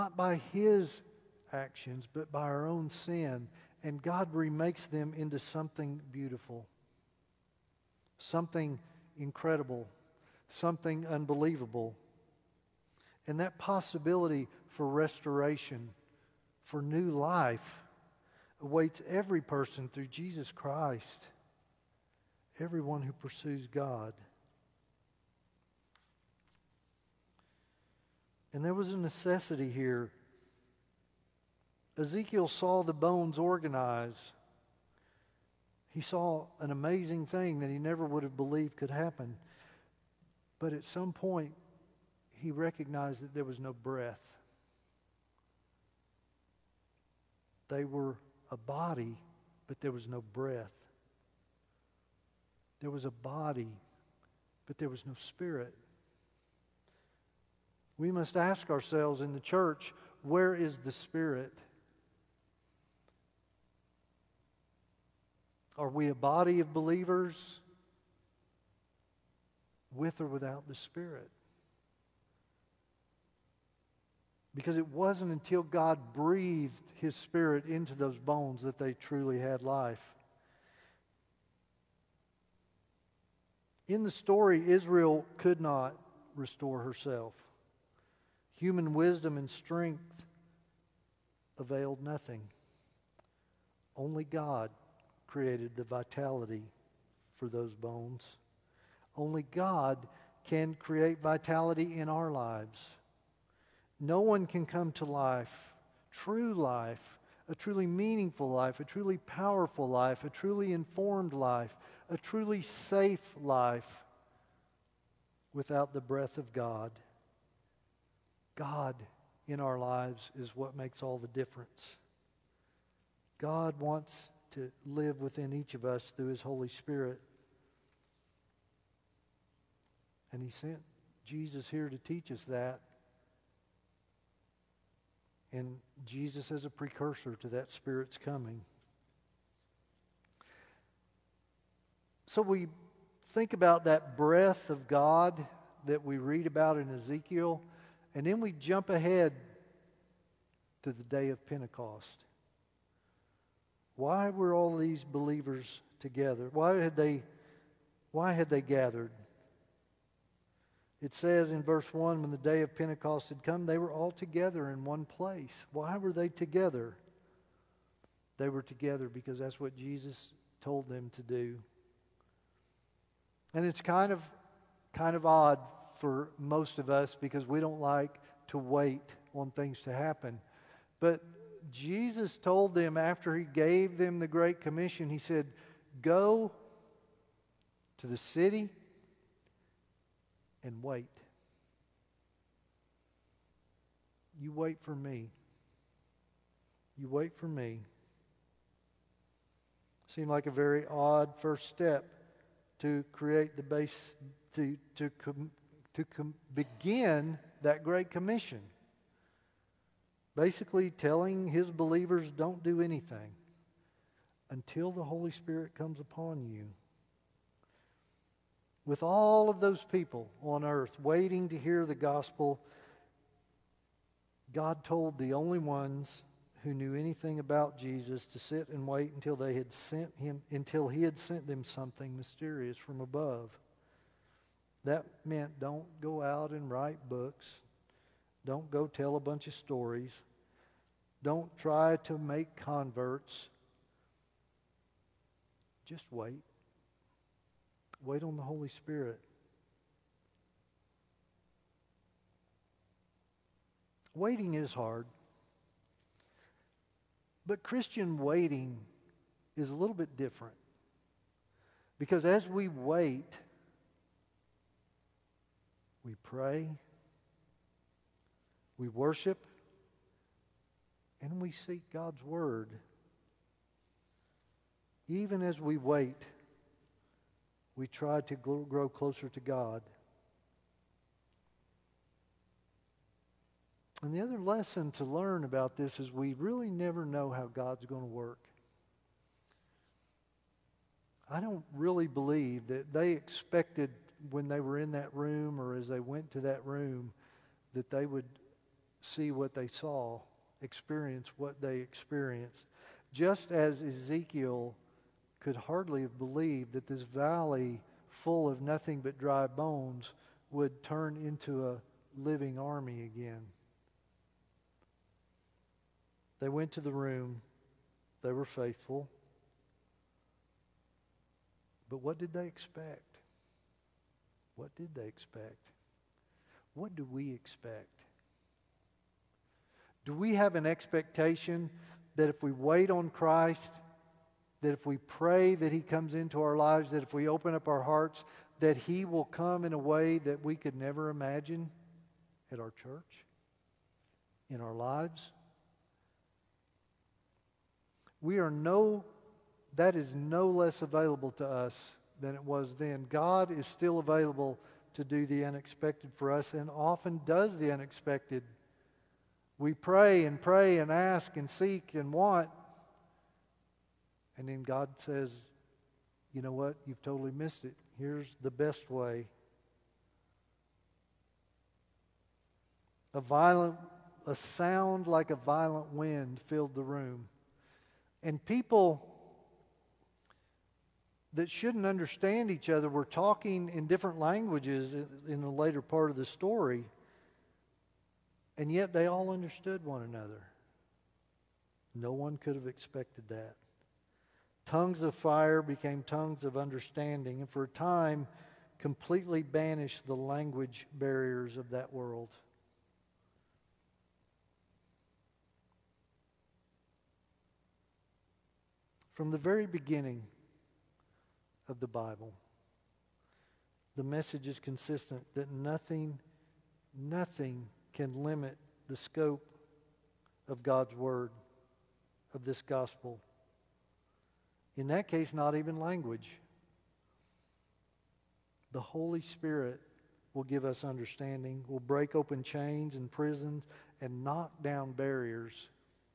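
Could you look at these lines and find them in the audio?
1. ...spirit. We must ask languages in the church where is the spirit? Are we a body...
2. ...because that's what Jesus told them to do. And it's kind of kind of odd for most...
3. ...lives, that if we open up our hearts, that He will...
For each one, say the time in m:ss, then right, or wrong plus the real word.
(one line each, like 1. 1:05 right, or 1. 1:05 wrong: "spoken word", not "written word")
1. 0:55 wrong: "ourselves", not "languages"
2. 2:49 right
3. 5:36 right.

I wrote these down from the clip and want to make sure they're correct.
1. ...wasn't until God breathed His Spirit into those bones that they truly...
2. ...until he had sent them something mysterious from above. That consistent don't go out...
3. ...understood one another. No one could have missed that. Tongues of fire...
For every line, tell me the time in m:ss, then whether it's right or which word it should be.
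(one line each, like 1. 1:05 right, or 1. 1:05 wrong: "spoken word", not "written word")
1. 1:14 right
2. 3:50 wrong: "meant", not "consistent"
3. 6:29 wrong: "expected", not "missed".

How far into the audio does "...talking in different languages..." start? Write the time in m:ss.
6:23.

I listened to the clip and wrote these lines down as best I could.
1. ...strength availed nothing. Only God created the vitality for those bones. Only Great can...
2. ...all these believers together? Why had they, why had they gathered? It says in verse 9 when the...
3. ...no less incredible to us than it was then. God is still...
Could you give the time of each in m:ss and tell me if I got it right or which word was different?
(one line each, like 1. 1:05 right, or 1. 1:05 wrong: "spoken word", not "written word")
1. 1:29 wrong: "God", not "Great"
2. 2:34 wrong: "1", not "9"
3. 5:50 wrong: "available", not "incredible".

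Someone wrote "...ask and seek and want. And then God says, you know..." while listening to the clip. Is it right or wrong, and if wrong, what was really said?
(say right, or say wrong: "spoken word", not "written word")
right.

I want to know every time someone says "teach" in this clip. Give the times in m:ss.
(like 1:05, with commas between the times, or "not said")
2:11.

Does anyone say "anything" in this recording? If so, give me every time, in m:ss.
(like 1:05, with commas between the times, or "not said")
3:32, 3:46.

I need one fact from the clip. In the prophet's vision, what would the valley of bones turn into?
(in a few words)
A living army.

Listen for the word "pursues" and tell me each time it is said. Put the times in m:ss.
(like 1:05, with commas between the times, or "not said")
0:23.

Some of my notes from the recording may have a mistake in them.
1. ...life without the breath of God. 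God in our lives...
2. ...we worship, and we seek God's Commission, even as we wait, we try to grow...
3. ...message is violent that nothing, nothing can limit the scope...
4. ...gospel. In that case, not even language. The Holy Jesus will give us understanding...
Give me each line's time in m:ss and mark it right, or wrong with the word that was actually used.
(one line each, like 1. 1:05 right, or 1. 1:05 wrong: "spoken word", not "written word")
1. 1:53 right
2. 4:28 wrong: "Word", not "Commission"
3. 6:54 wrong: "consistent", not "violent"
4. 7:02 wrong: "Spirit", not "Jesus".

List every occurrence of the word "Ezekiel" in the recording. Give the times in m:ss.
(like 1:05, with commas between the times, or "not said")
0:31, 2:26, 5:03.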